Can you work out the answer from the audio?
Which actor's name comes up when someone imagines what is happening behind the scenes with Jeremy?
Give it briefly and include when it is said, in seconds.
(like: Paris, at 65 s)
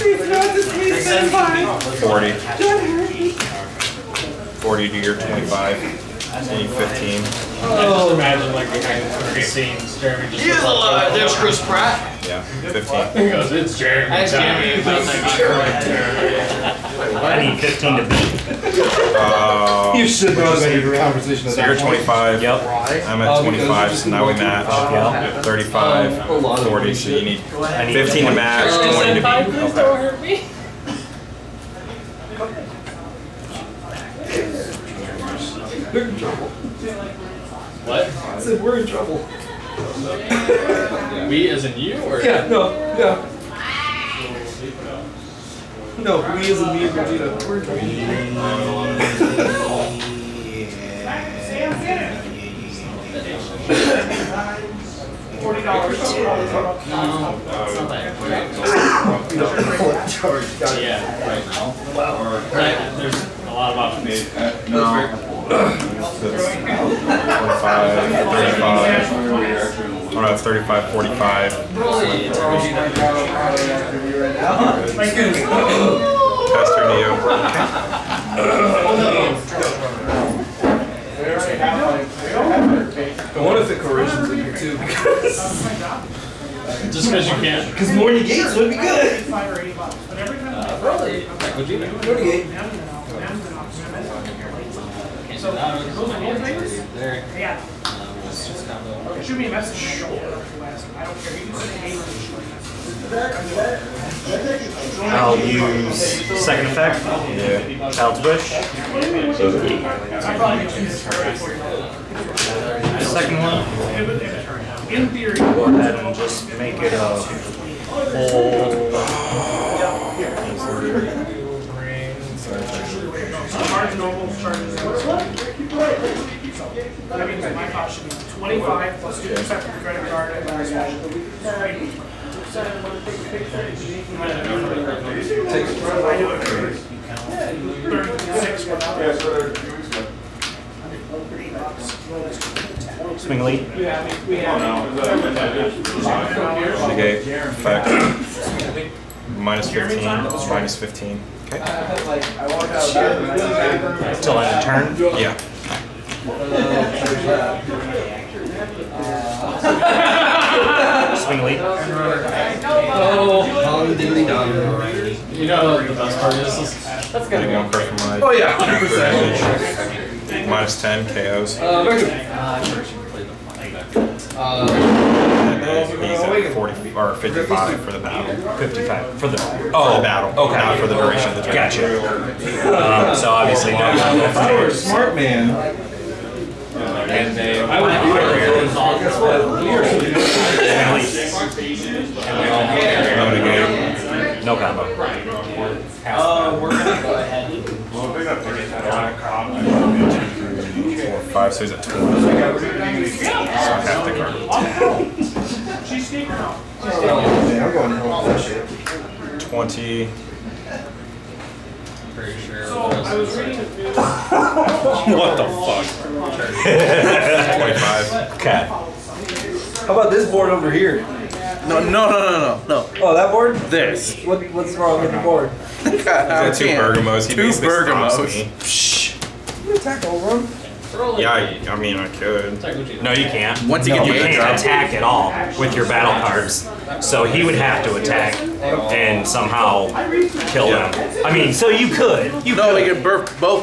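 Chris Pratt, at 11 s.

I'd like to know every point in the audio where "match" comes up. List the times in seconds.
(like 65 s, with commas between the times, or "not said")
24 s, 28 s.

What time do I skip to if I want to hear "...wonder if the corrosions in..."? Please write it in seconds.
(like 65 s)
83 s.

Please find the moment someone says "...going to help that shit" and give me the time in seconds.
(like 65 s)
207 s.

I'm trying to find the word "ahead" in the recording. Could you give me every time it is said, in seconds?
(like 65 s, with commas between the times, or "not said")
115 s, 197 s.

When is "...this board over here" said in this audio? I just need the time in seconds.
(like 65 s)
220 s.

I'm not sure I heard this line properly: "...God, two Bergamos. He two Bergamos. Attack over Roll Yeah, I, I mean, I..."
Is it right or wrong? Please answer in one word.
right.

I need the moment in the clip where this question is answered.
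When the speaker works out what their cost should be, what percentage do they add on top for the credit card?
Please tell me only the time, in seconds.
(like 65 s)
129 s.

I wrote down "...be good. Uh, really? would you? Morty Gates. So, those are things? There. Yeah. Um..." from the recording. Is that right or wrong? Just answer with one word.
right.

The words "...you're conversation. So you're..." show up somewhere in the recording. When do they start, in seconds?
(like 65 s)
20 s.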